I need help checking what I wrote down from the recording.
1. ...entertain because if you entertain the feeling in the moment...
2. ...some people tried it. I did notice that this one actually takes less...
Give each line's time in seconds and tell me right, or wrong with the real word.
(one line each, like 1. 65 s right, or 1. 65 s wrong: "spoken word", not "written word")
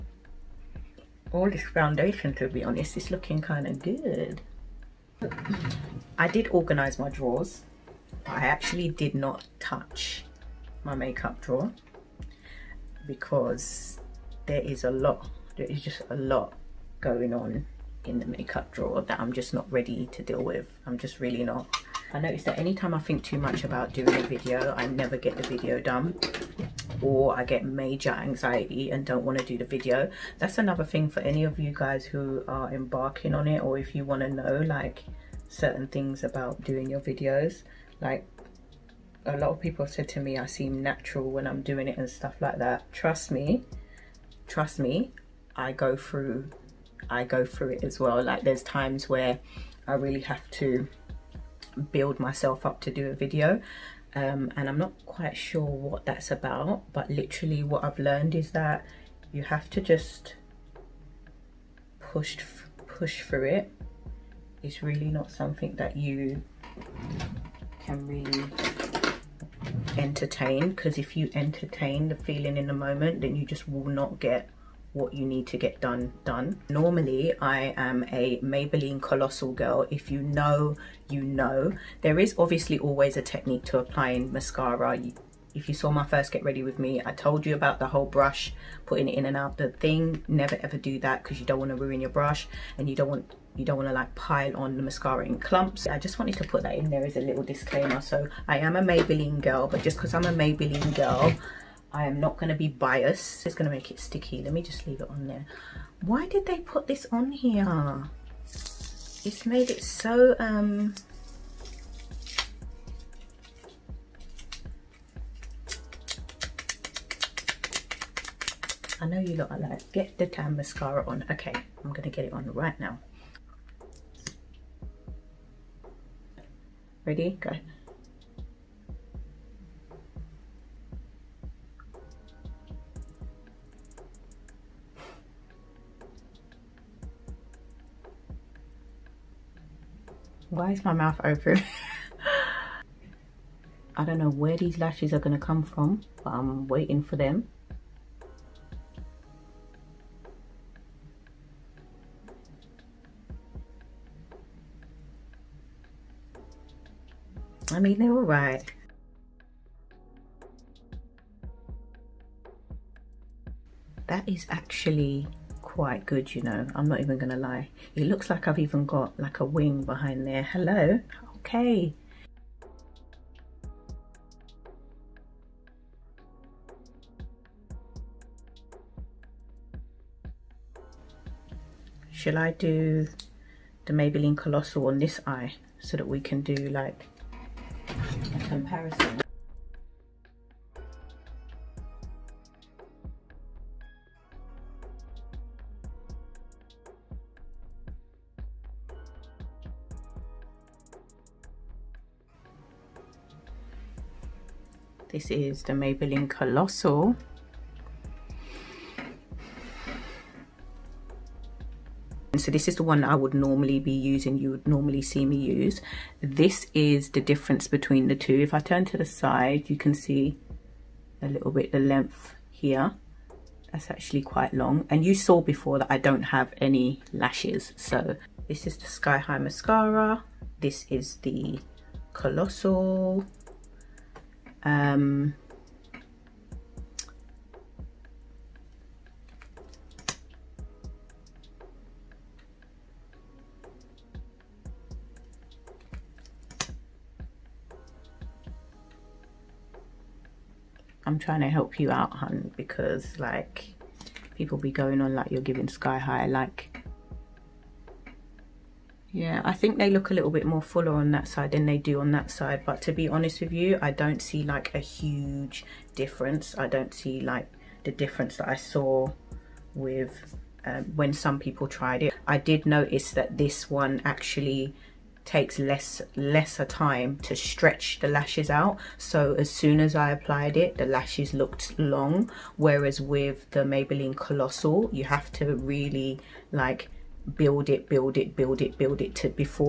1. 69 s right
2. 271 s right.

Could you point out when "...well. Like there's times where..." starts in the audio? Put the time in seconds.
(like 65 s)
47 s.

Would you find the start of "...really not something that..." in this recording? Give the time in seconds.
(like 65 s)
64 s.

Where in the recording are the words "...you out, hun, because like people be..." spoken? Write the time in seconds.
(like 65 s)
251 s.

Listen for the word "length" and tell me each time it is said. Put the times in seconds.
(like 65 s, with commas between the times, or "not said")
221 s.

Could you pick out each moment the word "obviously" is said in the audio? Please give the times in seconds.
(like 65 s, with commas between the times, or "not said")
82 s.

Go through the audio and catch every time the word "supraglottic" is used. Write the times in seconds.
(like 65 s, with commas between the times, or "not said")
not said.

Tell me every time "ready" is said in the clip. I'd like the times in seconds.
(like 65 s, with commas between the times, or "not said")
19 s, 86 s, 127 s.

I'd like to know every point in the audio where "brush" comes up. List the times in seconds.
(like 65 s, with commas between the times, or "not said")
88 s, 92 s.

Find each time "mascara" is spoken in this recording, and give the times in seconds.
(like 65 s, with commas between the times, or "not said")
84 s, 94 s, 120 s, 229 s.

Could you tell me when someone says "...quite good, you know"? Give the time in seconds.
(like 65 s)
165 s.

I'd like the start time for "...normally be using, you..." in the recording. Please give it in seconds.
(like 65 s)
213 s.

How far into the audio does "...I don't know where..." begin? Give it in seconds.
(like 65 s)
143 s.